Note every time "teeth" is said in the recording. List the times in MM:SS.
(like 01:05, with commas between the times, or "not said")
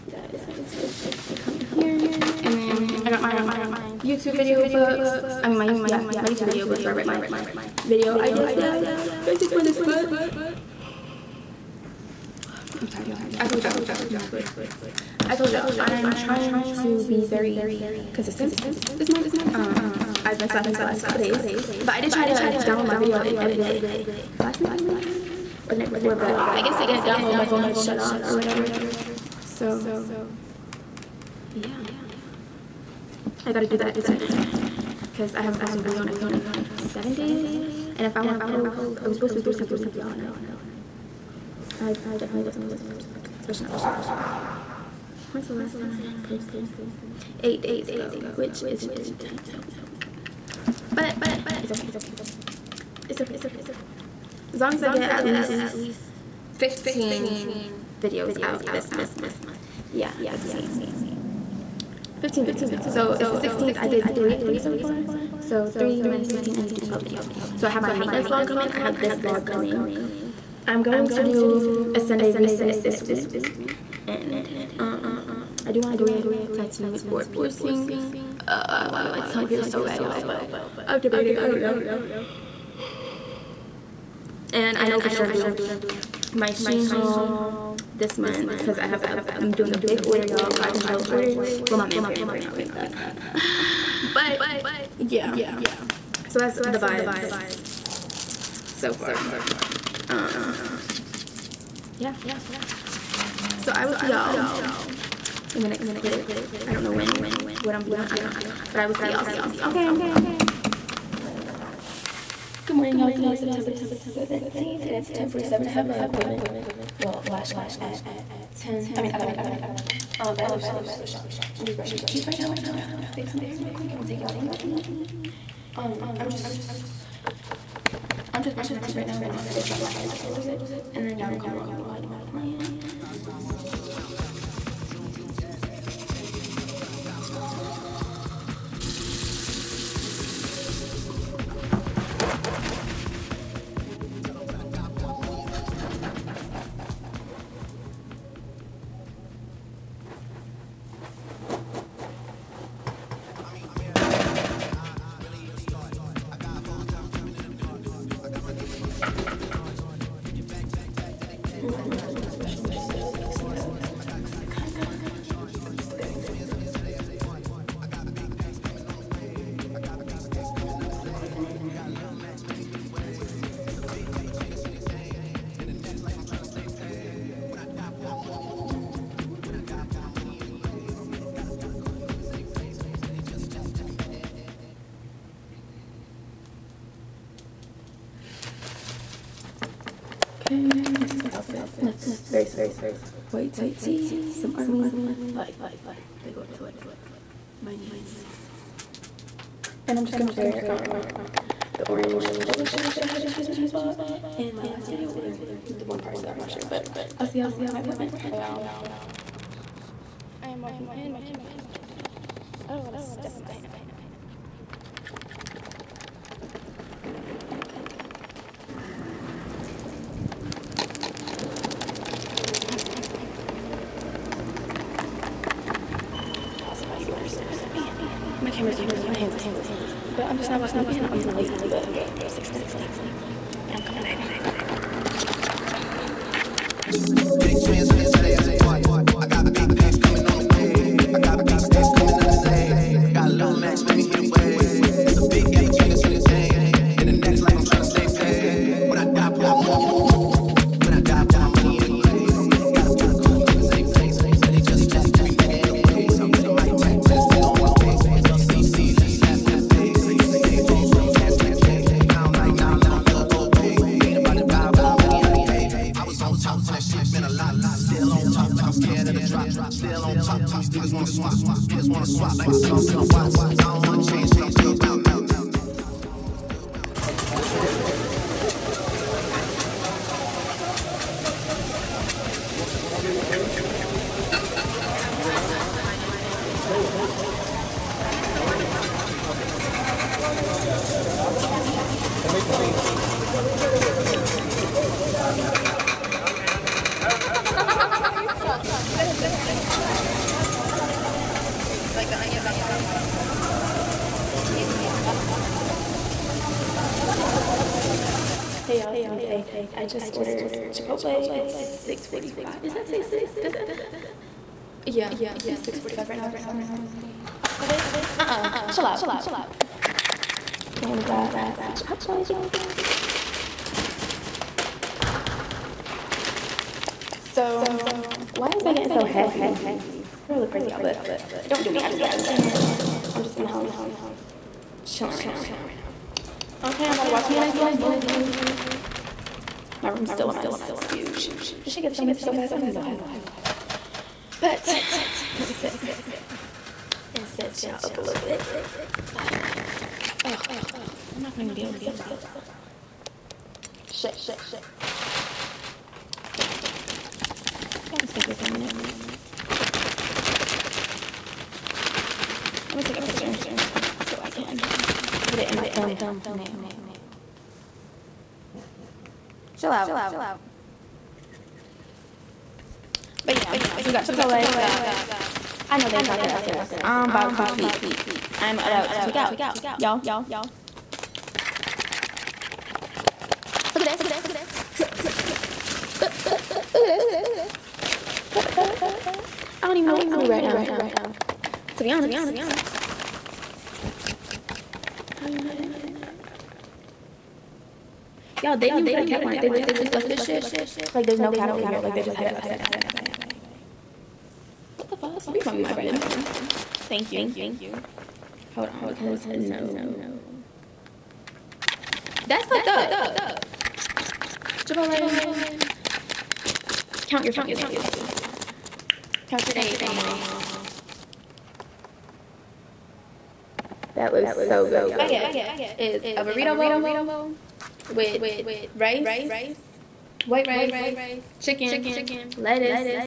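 02:02, 02:08.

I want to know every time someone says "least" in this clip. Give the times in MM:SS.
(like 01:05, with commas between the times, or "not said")
00:55.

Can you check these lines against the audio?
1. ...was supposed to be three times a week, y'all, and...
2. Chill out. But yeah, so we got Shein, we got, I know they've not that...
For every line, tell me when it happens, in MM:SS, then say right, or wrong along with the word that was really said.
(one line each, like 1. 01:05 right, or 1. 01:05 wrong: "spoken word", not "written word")
1. 00:39 right
2. 06:09 wrong: "Chipotle", not "Shein".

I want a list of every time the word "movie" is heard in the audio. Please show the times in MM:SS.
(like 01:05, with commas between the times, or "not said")
05:37.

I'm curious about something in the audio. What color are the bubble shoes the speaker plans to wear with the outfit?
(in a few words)
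Orange.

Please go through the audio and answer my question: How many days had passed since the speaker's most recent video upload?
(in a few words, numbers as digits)
8.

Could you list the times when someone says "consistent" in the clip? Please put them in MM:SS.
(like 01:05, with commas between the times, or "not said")
00:18.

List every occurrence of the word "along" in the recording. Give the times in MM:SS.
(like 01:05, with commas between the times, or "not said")
02:04, 02:11.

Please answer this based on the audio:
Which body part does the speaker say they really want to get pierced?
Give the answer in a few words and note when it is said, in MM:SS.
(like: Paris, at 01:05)
Tongue, at 01:19.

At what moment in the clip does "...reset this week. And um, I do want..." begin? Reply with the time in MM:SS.
01:12.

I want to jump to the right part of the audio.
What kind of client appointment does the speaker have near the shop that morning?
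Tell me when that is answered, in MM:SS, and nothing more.
01:57.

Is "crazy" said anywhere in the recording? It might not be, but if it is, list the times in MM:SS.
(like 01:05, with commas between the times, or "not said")
05:30.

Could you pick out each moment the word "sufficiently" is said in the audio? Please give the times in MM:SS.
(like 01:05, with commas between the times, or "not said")
not said.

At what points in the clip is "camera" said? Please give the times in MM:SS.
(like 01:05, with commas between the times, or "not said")
03:31, 03:48.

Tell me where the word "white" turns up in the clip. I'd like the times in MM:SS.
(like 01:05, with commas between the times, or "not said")
03:13, 07:10.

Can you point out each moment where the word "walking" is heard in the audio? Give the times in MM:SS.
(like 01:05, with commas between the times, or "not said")
03:30, 03:50.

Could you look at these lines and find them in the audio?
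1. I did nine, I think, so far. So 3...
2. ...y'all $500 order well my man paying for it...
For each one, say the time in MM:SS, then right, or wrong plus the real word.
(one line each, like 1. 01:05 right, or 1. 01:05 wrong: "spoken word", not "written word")
1. 01:03 wrong: "three", not "nine"
2. 01:30 right.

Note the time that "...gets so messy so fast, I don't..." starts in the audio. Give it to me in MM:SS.
05:41.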